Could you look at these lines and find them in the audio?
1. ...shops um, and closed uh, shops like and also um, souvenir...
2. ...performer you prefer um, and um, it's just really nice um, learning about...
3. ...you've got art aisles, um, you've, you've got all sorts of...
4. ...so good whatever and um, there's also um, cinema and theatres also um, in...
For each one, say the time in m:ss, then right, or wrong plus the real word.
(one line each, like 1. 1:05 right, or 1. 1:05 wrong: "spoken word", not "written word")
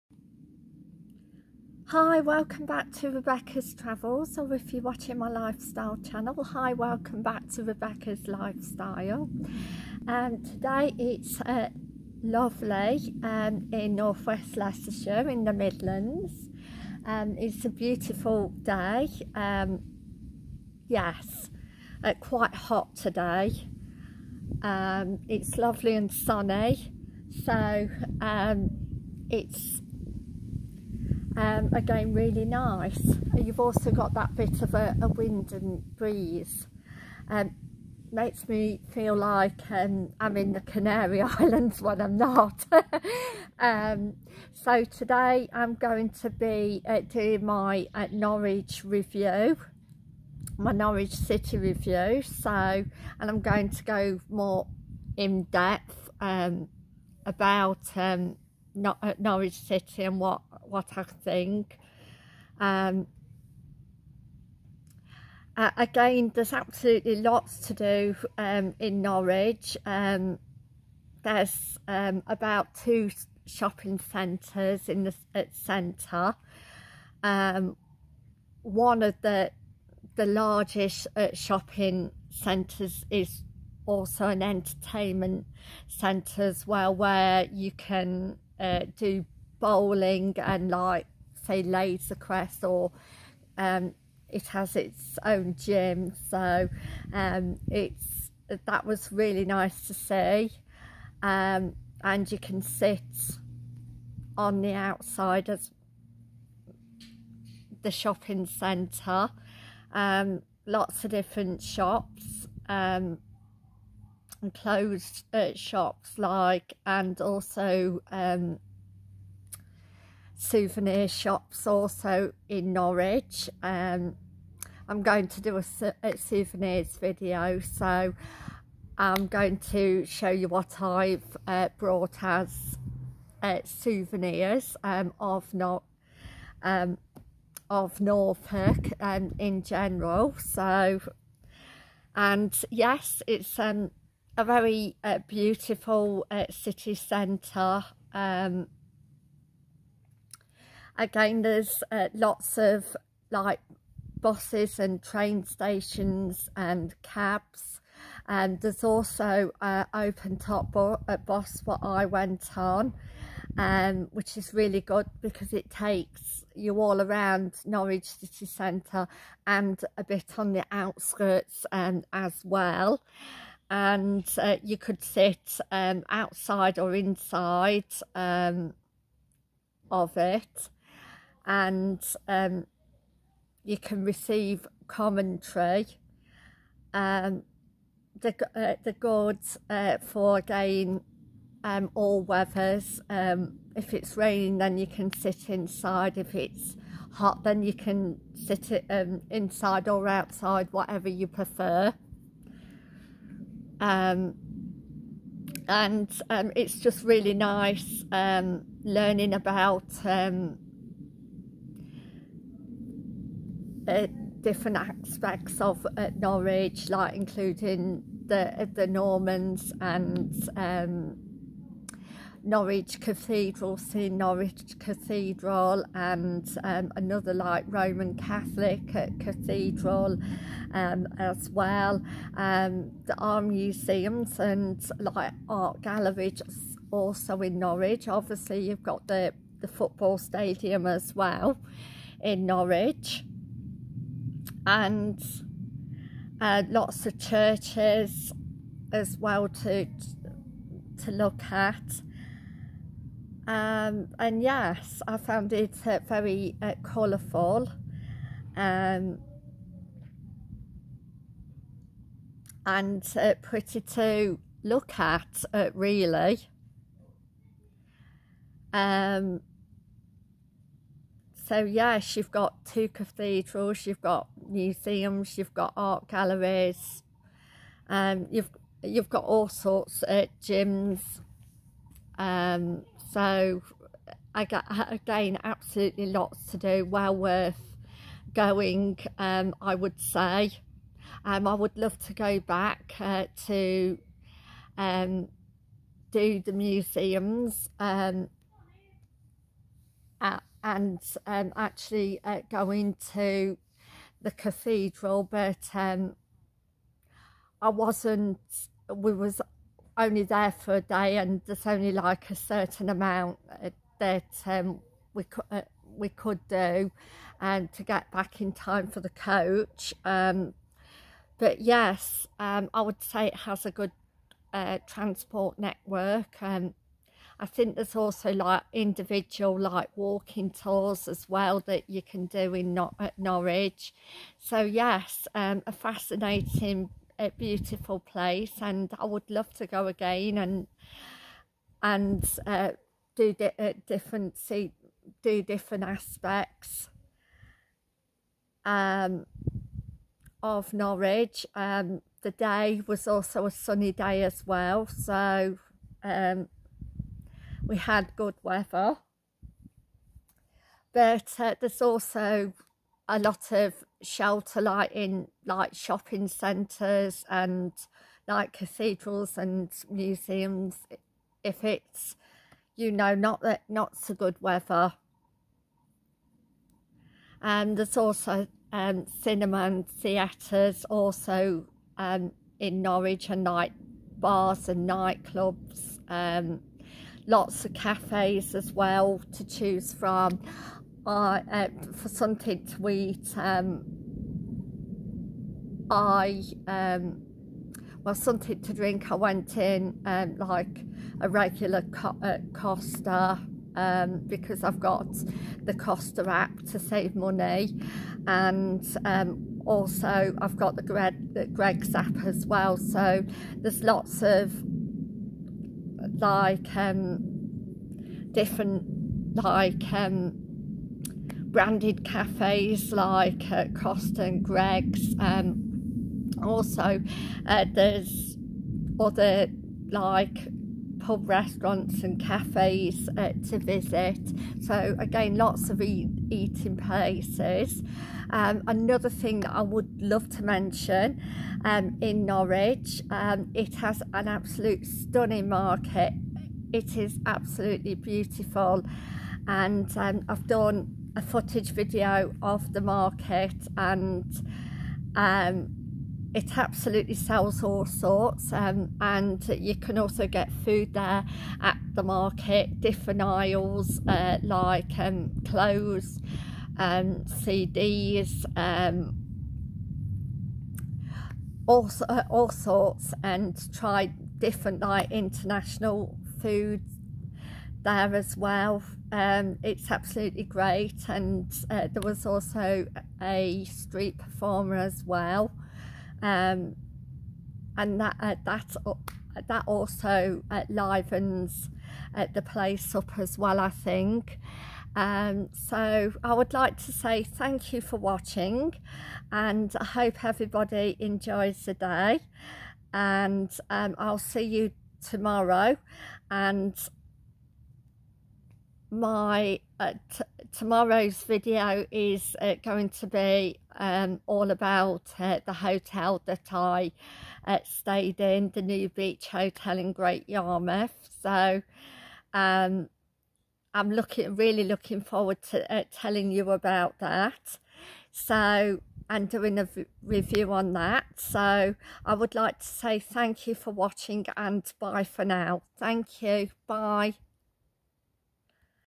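1. 1:51 right
2. 3:20 wrong: "whatever", not "performer"
3. 4:35 wrong: "galleries", not "aisles"
4. 6:13 wrong: "weather", not "whatever".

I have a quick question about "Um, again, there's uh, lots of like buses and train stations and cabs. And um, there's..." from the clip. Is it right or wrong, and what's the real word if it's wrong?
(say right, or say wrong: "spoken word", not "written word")
right.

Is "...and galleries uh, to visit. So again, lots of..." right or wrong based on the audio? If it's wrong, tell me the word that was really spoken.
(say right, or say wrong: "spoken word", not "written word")
wrong: "cafes", not "galleries".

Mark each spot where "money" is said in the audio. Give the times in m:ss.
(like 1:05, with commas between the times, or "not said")
6:47.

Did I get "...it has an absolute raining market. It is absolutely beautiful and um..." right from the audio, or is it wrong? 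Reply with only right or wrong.
wrong.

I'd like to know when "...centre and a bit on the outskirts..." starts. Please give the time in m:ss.
2:48.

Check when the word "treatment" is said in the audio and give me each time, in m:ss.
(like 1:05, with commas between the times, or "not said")
not said.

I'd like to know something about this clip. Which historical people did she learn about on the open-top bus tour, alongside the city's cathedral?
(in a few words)
The Normans.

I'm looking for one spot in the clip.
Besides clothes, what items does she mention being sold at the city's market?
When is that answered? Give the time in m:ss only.
7:47.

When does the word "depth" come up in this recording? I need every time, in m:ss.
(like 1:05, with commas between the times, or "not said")
0:55.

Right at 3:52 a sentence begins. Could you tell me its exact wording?
Um, the art museums and like art galleries also in Norwich.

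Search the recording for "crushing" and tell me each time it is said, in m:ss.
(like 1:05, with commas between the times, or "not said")
not said.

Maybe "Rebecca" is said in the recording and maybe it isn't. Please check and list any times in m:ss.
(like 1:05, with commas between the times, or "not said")
0:03, 0:07.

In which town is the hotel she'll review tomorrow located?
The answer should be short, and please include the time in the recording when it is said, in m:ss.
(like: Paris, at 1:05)
Great Yarmouth, at 8:39.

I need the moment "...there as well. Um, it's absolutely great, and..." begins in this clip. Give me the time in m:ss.
7:57.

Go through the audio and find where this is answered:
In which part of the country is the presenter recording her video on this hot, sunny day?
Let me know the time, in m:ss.
0:13.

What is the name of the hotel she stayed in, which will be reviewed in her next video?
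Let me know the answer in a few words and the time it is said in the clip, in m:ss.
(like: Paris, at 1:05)
New Beach Hotel, at 8:38.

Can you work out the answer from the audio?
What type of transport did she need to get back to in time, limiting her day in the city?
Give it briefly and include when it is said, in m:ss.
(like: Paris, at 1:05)
Coach, at 5:19.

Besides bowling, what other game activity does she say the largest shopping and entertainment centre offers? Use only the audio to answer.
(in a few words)
Laser quest.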